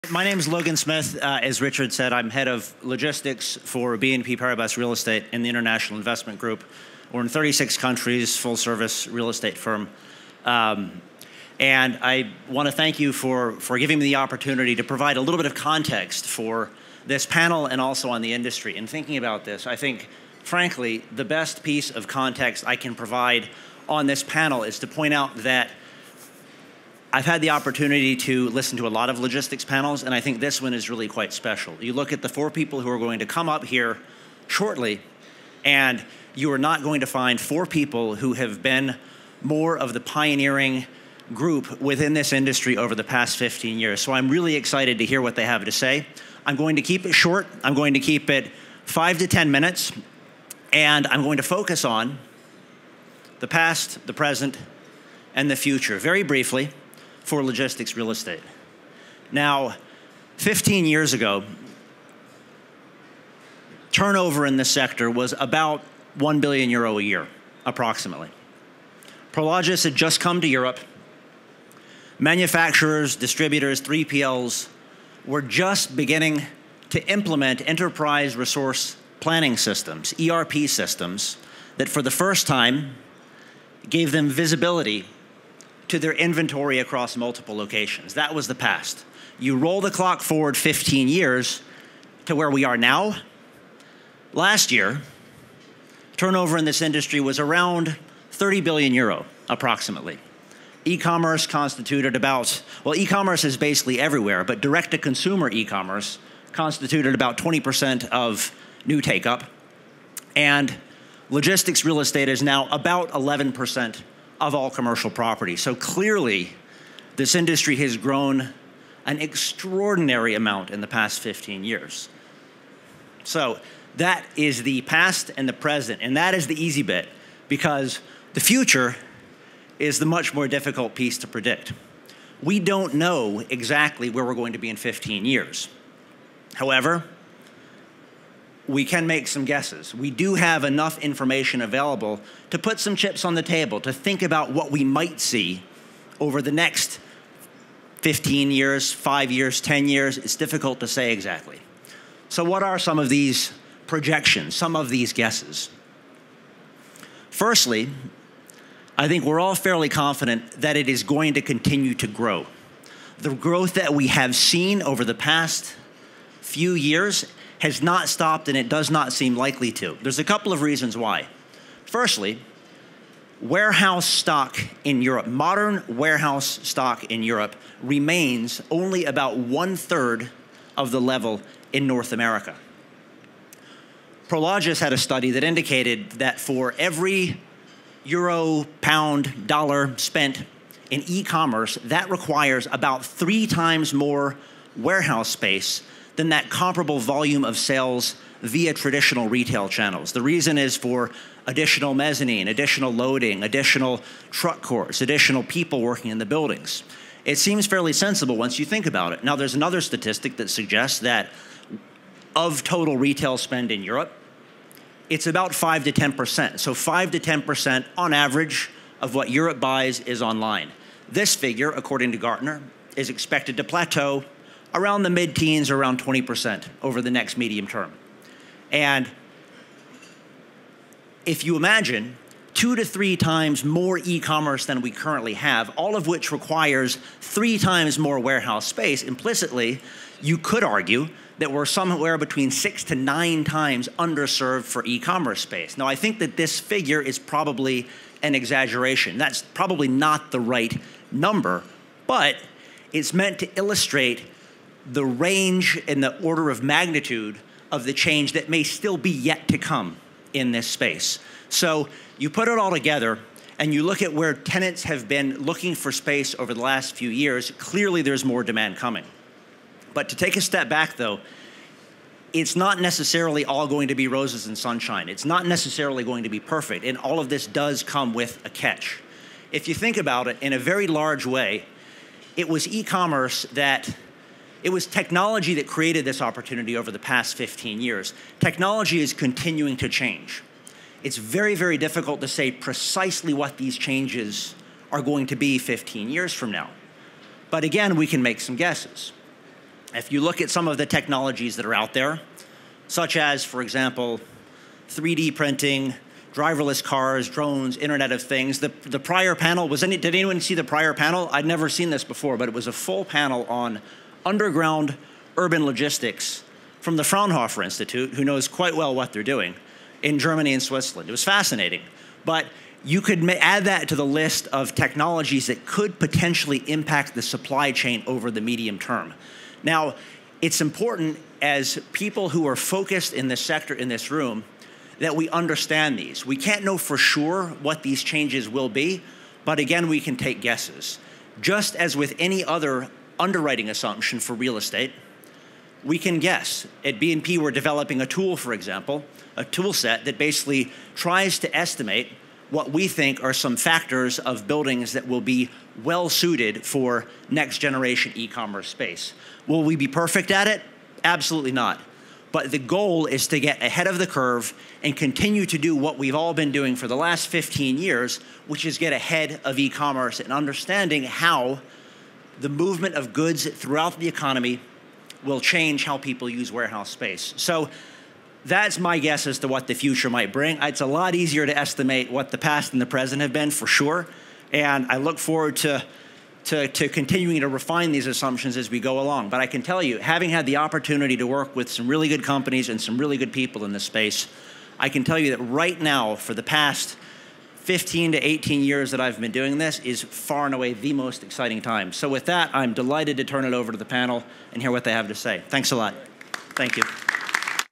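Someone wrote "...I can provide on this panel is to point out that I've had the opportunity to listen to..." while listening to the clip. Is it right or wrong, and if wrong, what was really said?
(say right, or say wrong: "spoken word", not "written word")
right.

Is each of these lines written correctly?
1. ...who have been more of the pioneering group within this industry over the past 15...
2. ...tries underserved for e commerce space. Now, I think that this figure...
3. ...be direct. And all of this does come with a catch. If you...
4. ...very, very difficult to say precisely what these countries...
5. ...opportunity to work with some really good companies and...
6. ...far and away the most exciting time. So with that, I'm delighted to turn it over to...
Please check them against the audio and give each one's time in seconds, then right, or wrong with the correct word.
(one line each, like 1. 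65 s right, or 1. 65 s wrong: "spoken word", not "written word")
1. 38 s right
2. 243 s wrong: "times", not "tries"
3. 276 s wrong: "perfect", not "direct"
4. 291 s wrong: "changes", not "countries"
5. 390 s right
6. 400 s right.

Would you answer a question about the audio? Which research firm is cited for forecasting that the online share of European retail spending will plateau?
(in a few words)
Gartner.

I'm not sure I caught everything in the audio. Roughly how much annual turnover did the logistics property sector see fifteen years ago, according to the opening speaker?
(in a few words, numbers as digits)
1 billion euro.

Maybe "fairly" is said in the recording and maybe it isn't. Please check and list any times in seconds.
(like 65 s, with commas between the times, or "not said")
159 s, 207 s.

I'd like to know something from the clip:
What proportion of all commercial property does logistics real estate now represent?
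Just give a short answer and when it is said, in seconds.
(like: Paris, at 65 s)
11%, at 113 s.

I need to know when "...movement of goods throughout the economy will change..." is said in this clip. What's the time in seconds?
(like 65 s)
372 s.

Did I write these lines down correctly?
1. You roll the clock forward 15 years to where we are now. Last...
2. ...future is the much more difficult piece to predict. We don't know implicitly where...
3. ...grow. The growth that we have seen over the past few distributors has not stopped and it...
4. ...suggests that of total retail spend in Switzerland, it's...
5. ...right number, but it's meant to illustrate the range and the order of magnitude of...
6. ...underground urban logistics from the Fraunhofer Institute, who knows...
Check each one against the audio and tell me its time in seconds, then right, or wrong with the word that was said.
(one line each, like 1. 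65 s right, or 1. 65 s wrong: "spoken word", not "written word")
1. 89 s right
2. 128 s wrong: "exactly", not "implicitly"
3. 162 s wrong: "years", not "distributors"
4. 210 s wrong: "Europe", not "Switzerland"
5. 250 s right
6. 314 s right.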